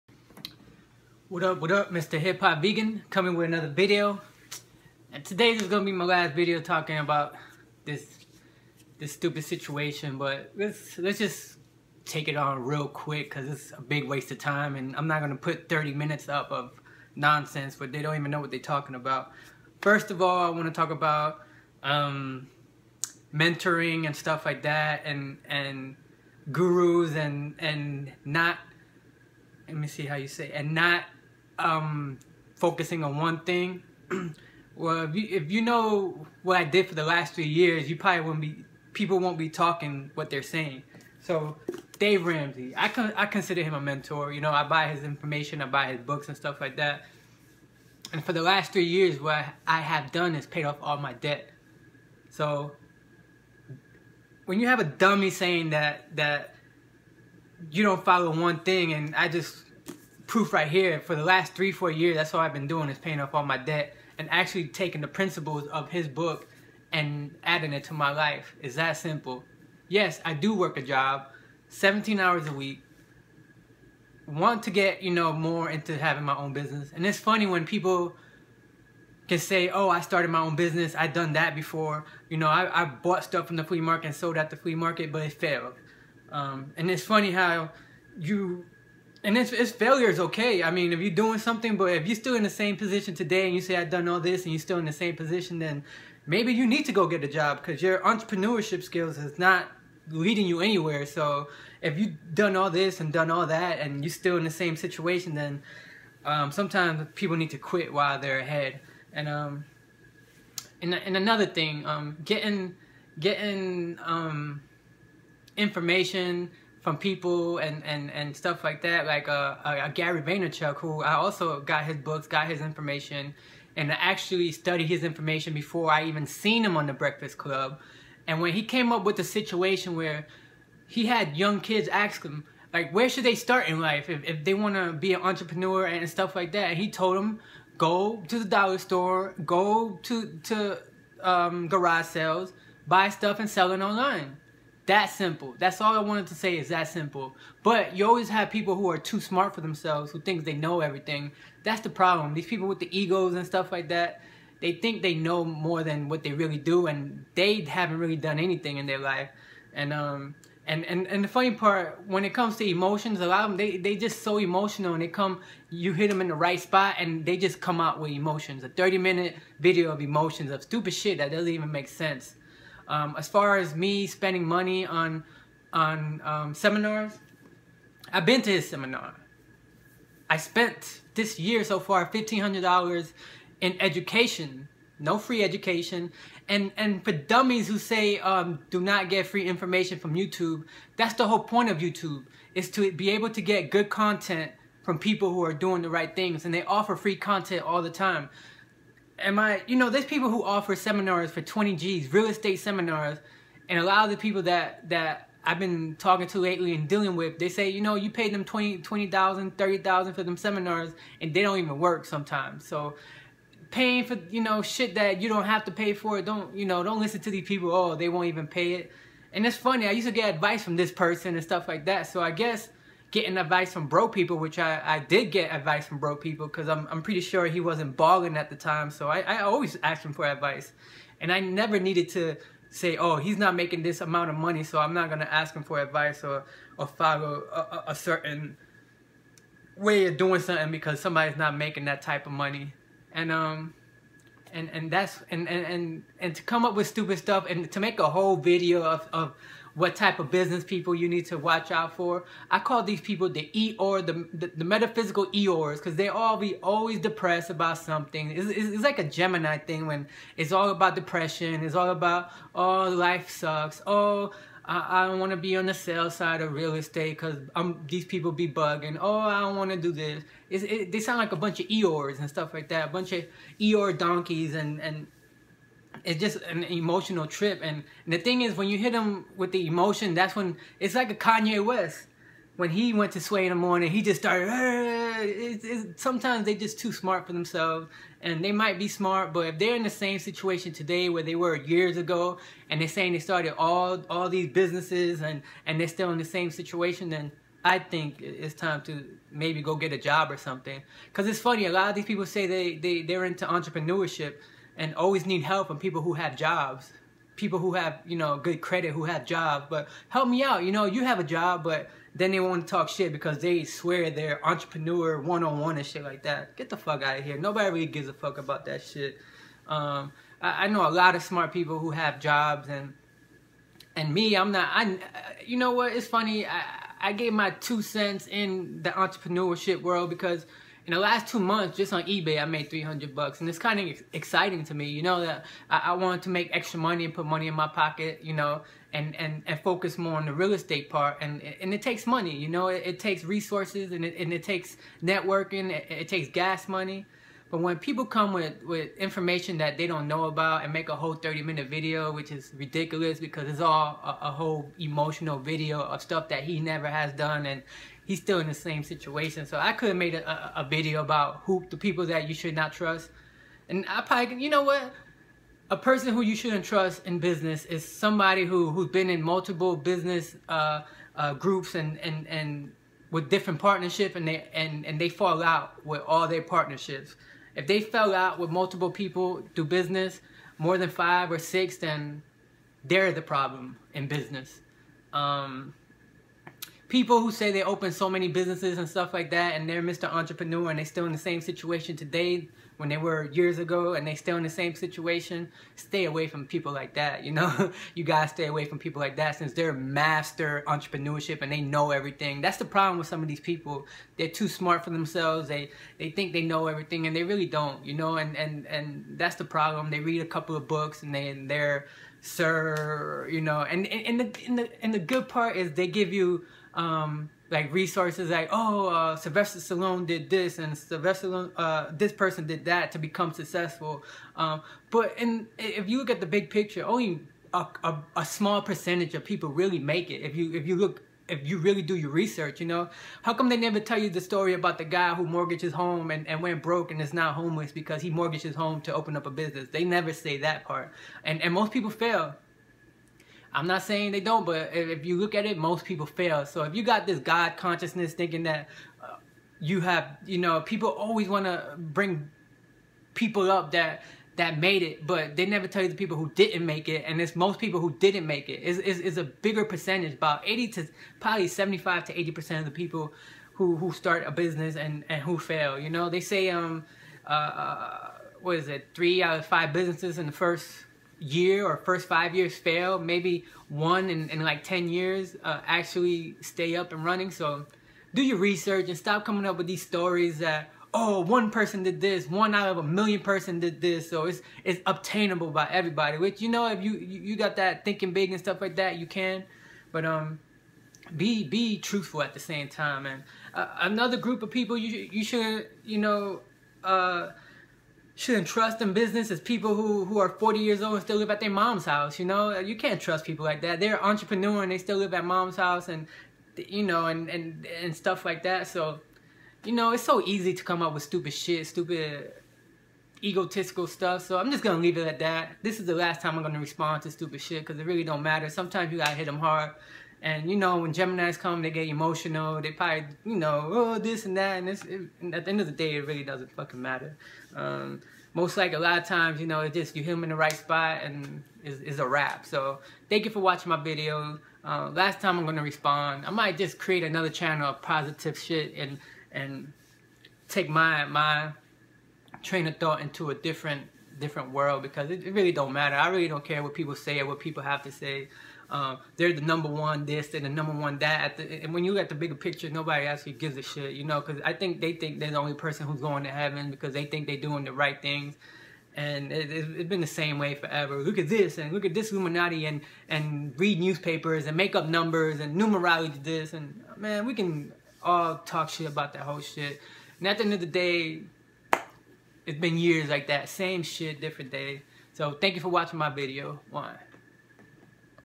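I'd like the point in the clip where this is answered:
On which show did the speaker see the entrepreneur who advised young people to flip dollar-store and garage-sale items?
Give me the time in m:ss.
2:06.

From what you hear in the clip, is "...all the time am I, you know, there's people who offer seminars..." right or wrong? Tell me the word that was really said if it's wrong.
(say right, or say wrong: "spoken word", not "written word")
right.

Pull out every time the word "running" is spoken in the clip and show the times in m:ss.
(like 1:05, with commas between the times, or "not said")
7:57.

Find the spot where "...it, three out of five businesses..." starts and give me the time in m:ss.
7:48.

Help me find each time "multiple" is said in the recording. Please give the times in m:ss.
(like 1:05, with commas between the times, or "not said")
6:09, 6:18.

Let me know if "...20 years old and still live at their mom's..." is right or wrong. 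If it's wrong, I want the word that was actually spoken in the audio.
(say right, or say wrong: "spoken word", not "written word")
wrong: "40", not "20".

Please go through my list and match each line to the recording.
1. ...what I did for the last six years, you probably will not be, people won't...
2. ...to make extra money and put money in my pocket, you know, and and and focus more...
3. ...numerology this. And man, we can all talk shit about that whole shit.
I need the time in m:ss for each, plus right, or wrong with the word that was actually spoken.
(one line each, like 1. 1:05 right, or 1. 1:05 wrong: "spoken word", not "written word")
1. 0:36 wrong: "three", not "six"
2. 5:36 right
3. 9:25 right.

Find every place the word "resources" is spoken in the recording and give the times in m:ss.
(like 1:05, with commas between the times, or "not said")
5:43, 6:57.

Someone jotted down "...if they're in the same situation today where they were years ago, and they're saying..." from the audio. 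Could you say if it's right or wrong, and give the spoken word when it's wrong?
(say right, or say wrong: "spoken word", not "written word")
right.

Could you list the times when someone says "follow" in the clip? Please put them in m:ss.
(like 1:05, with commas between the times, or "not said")
0:58, 3:56.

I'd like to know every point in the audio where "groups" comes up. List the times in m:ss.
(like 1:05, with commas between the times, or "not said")
6:11, 8:14.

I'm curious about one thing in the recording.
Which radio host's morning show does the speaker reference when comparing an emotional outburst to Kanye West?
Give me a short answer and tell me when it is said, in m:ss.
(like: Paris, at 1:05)
Sway, at 4:43.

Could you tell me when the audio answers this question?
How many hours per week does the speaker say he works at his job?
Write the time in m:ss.
1:11.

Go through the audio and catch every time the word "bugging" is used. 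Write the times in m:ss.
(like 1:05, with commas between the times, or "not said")
4:28.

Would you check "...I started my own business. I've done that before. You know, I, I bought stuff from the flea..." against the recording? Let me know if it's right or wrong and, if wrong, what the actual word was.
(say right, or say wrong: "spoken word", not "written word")
right.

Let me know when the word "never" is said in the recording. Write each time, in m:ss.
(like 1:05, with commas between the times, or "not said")
3:51, 5:56, 7:13, 7:19, 7:35.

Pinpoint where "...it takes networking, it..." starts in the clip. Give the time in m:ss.
5:44.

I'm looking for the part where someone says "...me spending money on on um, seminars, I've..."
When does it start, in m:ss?
2:53.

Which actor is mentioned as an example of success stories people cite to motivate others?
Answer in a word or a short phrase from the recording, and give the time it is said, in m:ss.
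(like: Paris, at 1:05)
Sylvester Stallone, at 6:59.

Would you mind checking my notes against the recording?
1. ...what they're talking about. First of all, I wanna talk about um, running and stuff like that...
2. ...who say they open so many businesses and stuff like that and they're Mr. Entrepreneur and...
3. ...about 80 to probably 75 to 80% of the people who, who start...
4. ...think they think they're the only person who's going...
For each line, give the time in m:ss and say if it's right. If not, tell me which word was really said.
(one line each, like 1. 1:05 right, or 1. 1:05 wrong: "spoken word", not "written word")
1. 0:18 wrong: "mentoring", not "running"
2. 6:27 right
3. 7:40 right
4. 9:14 right.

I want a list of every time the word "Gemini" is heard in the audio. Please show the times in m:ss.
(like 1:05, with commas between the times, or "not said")
4:19, 8:40.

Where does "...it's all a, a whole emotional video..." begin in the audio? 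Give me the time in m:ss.
5:53.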